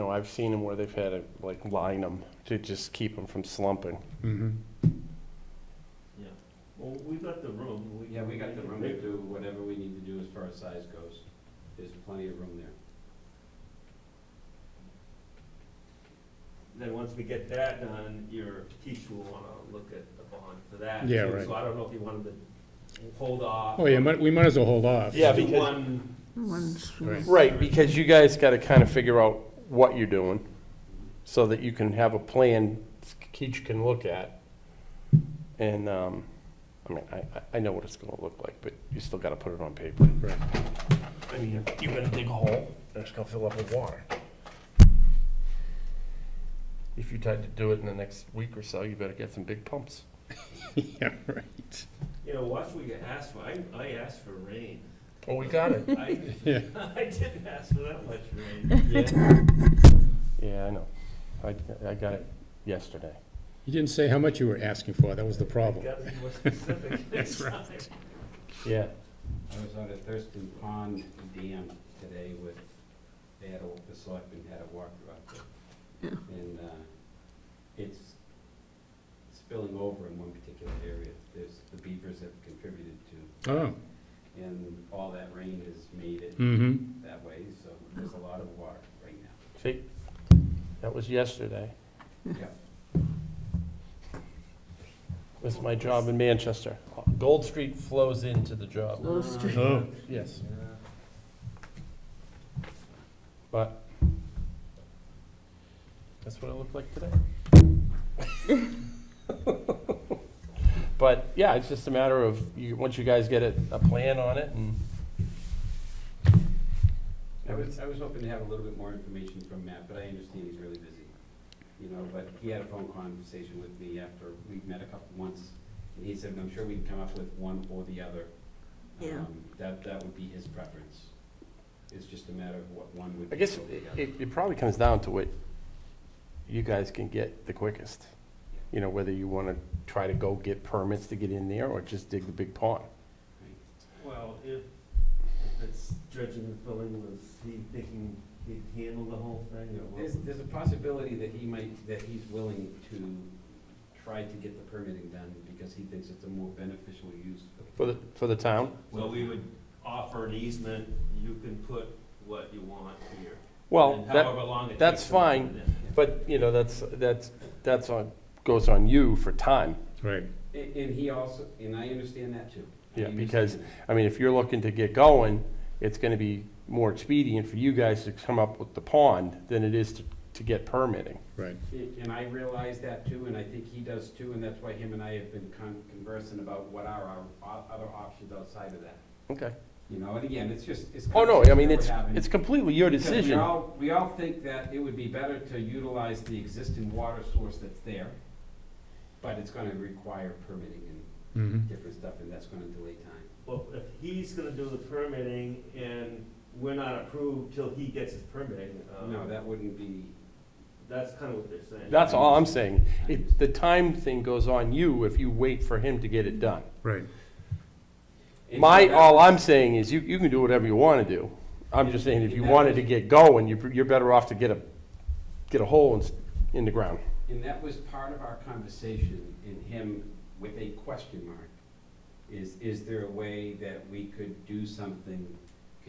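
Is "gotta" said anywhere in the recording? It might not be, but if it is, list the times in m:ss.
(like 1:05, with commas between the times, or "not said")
0:28, 0:39, 1:05.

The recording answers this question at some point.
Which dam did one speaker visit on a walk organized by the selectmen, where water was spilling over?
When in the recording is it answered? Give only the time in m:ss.
1:09.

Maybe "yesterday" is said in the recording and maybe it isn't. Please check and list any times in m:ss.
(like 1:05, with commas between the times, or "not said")
1:02, 1:31.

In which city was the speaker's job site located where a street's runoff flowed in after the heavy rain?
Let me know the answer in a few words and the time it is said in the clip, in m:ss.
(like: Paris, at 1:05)
Manchester, at 1:36.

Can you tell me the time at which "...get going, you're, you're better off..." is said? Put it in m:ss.
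3:42.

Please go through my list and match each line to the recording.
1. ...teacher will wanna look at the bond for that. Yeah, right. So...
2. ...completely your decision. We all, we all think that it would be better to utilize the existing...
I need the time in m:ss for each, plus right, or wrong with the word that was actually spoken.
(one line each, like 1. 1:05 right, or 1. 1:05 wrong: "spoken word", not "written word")
1. 0:18 right
2. 3:12 right.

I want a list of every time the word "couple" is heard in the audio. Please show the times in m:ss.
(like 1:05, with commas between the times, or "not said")
2:04.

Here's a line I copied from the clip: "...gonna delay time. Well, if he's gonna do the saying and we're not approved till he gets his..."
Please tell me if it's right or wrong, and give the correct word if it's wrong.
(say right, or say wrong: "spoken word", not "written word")
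wrong: "permitting", not "saying".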